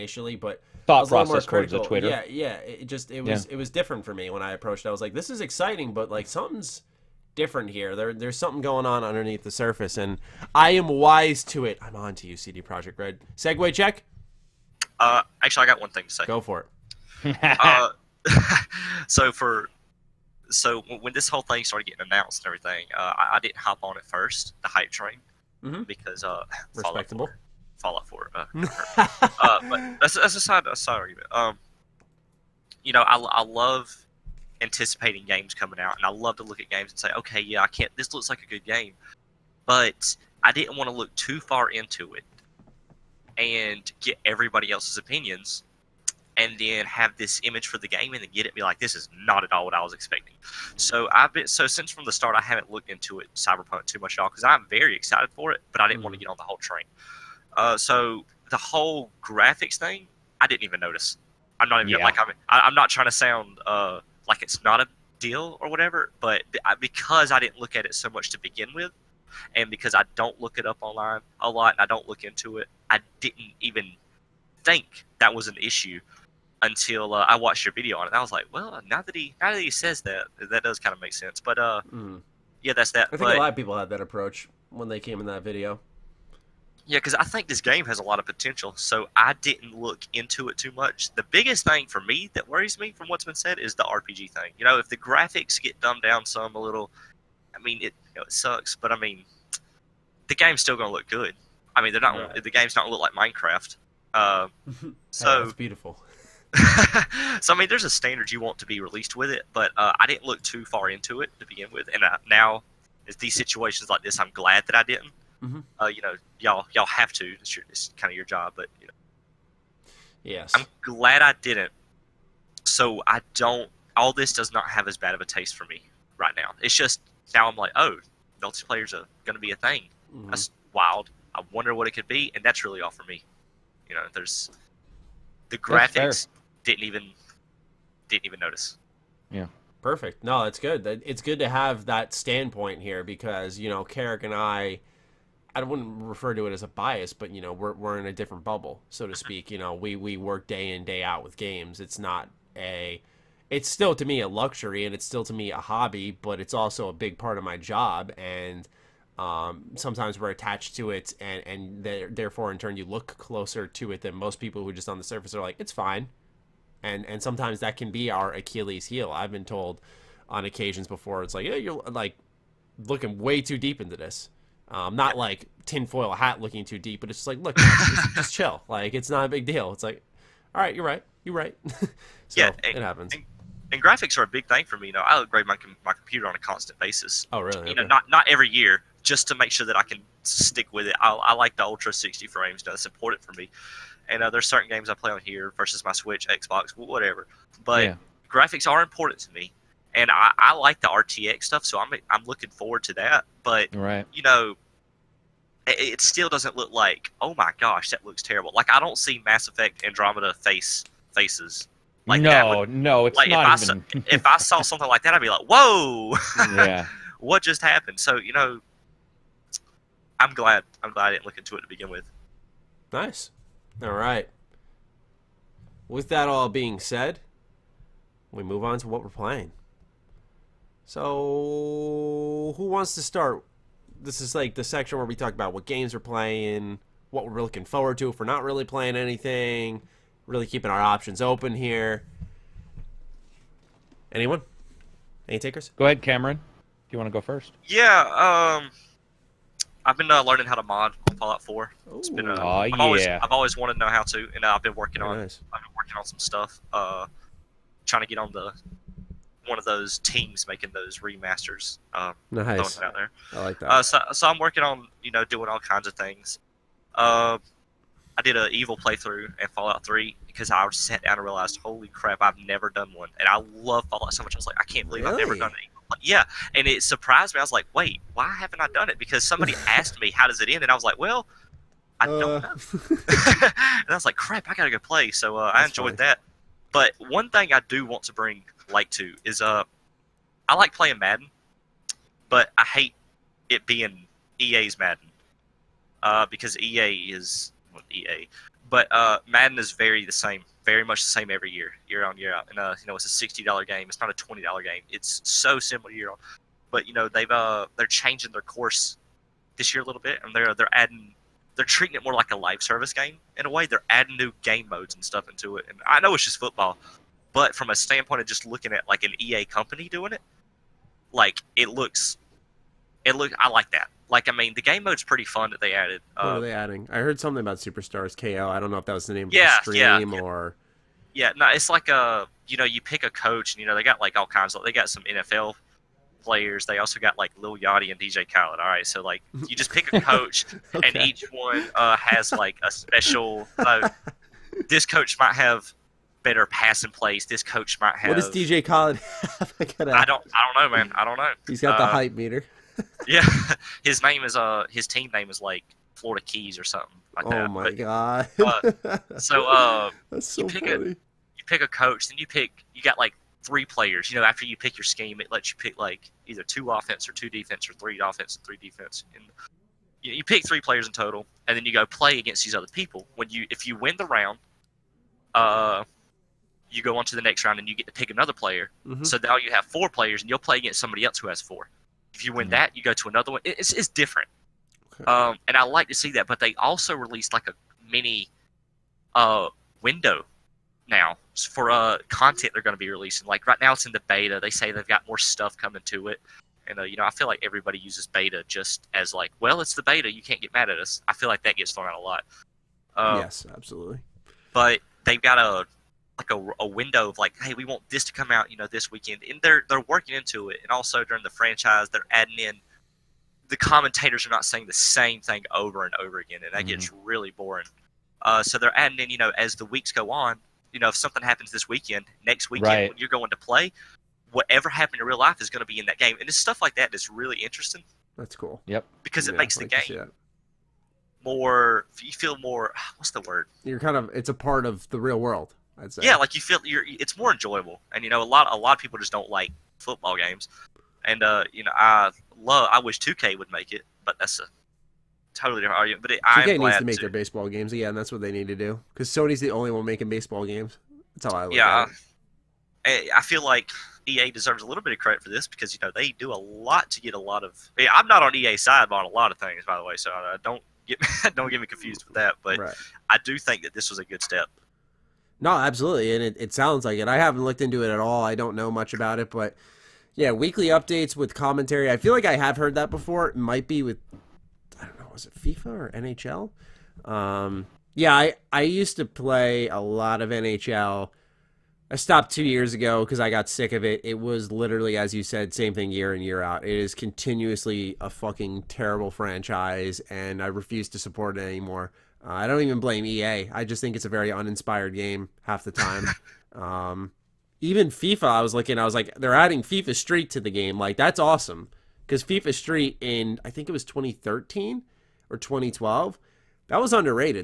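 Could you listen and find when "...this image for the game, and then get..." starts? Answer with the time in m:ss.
0:47.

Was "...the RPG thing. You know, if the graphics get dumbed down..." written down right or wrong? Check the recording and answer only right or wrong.
right.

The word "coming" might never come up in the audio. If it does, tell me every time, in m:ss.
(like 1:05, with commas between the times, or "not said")
0:35, 6:35.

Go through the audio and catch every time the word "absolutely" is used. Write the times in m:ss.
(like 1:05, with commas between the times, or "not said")
6:43, 7:45.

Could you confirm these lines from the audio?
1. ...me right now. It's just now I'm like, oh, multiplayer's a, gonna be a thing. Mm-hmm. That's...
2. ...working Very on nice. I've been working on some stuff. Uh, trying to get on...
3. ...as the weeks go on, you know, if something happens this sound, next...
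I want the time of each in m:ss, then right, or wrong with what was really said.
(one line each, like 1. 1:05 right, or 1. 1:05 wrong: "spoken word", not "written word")
1. 2:05 right
2. 4:14 right
3. 6:59 wrong: "weekend", not "sound".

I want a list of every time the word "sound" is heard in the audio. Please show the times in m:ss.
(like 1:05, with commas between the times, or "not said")
1:03, 7:46.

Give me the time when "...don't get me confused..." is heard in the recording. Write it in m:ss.
7:41.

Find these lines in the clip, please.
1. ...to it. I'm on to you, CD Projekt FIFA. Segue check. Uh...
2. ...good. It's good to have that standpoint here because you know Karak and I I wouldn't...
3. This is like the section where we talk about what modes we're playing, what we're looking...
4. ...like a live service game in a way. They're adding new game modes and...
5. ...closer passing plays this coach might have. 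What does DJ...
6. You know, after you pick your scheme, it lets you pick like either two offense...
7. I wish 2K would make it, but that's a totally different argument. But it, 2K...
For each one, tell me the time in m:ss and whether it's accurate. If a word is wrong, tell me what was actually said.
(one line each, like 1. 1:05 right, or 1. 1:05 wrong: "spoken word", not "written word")
1. 0:11 wrong: "Red", not "FIFA"
2. 2:20 right
3. 3:53 wrong: "games", not "modes"
4. 5:12 right
5. 5:46 wrong: "better", not "closer"
6. 6:04 right
7. 7:22 right.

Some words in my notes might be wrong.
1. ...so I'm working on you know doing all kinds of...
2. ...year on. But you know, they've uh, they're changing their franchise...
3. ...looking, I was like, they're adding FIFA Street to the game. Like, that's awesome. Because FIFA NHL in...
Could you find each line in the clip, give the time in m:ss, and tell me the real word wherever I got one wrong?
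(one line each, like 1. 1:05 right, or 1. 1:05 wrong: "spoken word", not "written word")
1. 4:24 right
2. 5:05 wrong: "course", not "franchise"
3. 8:18 wrong: "Street", not "NHL".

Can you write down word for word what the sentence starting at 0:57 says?
Uh, so the whole graphics thing, I didn't even notice.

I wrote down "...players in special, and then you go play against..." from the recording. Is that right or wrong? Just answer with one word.
wrong.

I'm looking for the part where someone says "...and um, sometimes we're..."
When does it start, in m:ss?
2:38.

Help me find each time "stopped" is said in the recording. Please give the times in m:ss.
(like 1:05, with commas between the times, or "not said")
8:01.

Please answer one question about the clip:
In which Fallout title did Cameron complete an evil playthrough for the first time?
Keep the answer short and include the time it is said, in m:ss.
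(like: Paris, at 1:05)
Fallout 3, at 4:29.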